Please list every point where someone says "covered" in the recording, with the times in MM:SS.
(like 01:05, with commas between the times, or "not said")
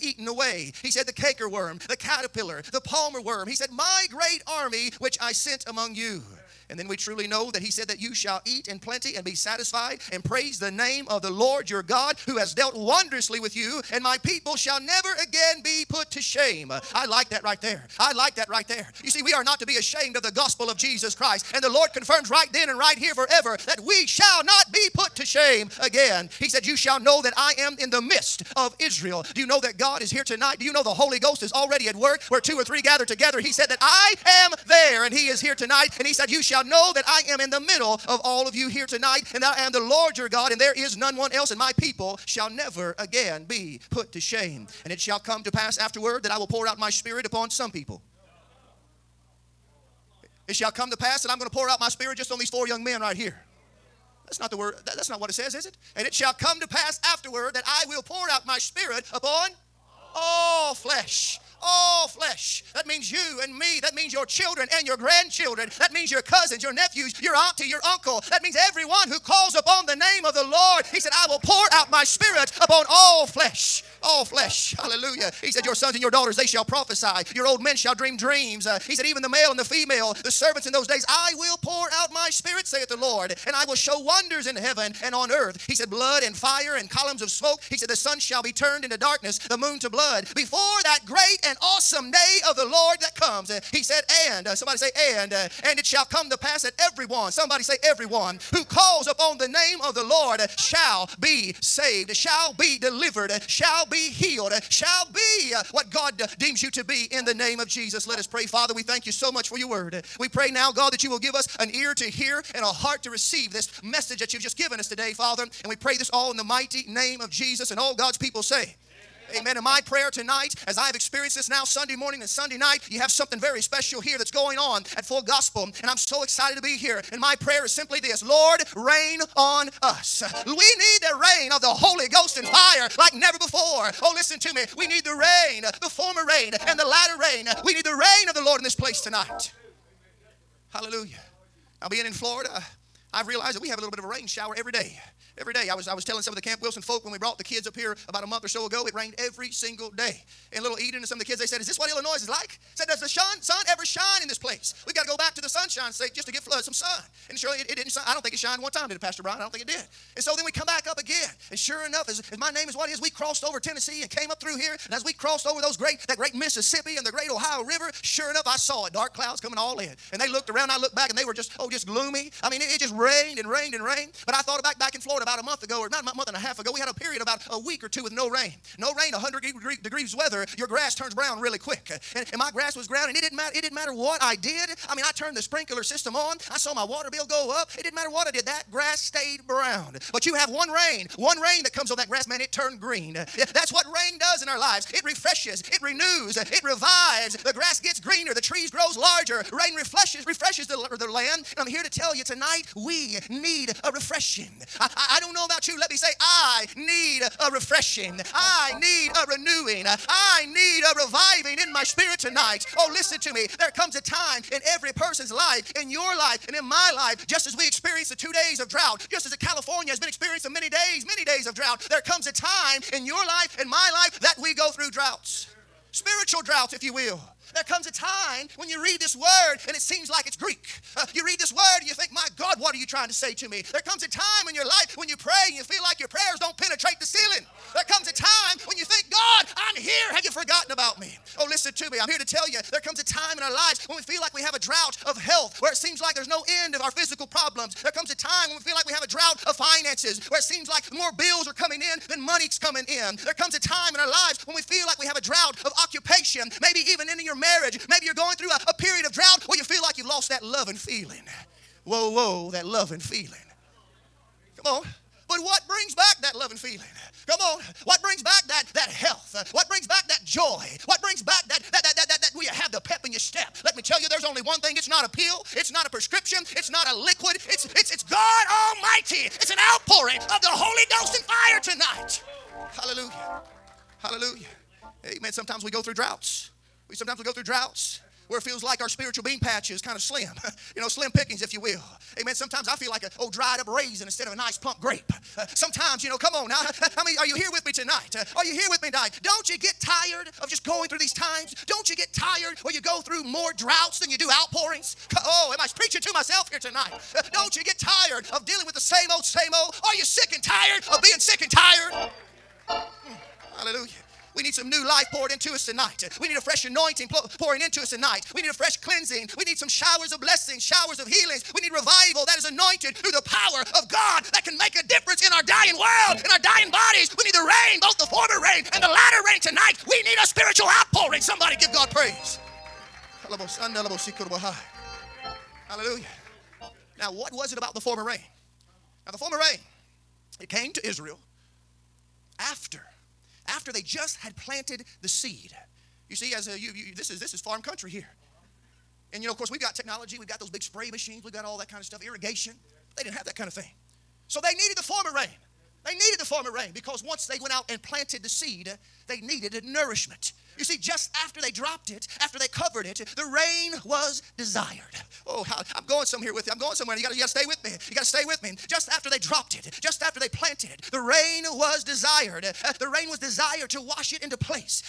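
06:02.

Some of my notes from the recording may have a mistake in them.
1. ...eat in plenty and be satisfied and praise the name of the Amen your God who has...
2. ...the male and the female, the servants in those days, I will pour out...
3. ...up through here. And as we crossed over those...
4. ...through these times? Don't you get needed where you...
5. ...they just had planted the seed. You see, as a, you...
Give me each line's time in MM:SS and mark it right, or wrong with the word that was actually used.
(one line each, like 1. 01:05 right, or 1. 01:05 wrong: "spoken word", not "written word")
1. 00:08 wrong: "Lord", not "Amen"
2. 01:19 right
3. 02:44 right
4. 05:00 wrong: "tired", not "needed"
5. 05:43 right.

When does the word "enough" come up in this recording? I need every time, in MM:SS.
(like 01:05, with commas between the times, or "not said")
02:41, 02:48.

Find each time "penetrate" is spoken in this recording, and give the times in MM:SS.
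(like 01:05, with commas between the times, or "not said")
03:56.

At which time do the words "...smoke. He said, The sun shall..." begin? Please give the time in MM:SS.
01:27.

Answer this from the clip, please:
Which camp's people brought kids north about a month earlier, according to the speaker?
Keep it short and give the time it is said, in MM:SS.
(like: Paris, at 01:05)
Camp Wilson, at 02:26.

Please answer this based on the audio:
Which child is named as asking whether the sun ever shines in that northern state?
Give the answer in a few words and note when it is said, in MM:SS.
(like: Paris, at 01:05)
Eden, at 02:30.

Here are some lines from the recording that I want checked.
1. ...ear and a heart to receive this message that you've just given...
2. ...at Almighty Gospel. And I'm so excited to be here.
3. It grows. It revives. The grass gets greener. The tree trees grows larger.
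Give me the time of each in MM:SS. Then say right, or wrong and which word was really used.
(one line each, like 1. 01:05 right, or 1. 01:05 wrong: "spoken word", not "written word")
1. 01:52 right
2. 02:04 wrong: "Full", not "Almighty"
3. 03:15 wrong: "renews", not "grows".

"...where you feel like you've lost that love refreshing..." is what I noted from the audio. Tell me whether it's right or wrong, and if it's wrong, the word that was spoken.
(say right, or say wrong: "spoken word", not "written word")
wrong: "loving", not "refreshing".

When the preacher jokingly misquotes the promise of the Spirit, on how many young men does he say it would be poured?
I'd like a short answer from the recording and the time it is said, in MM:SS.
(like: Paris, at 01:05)
4, at 00:52.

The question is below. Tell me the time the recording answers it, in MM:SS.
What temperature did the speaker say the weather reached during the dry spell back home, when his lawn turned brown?
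02:59.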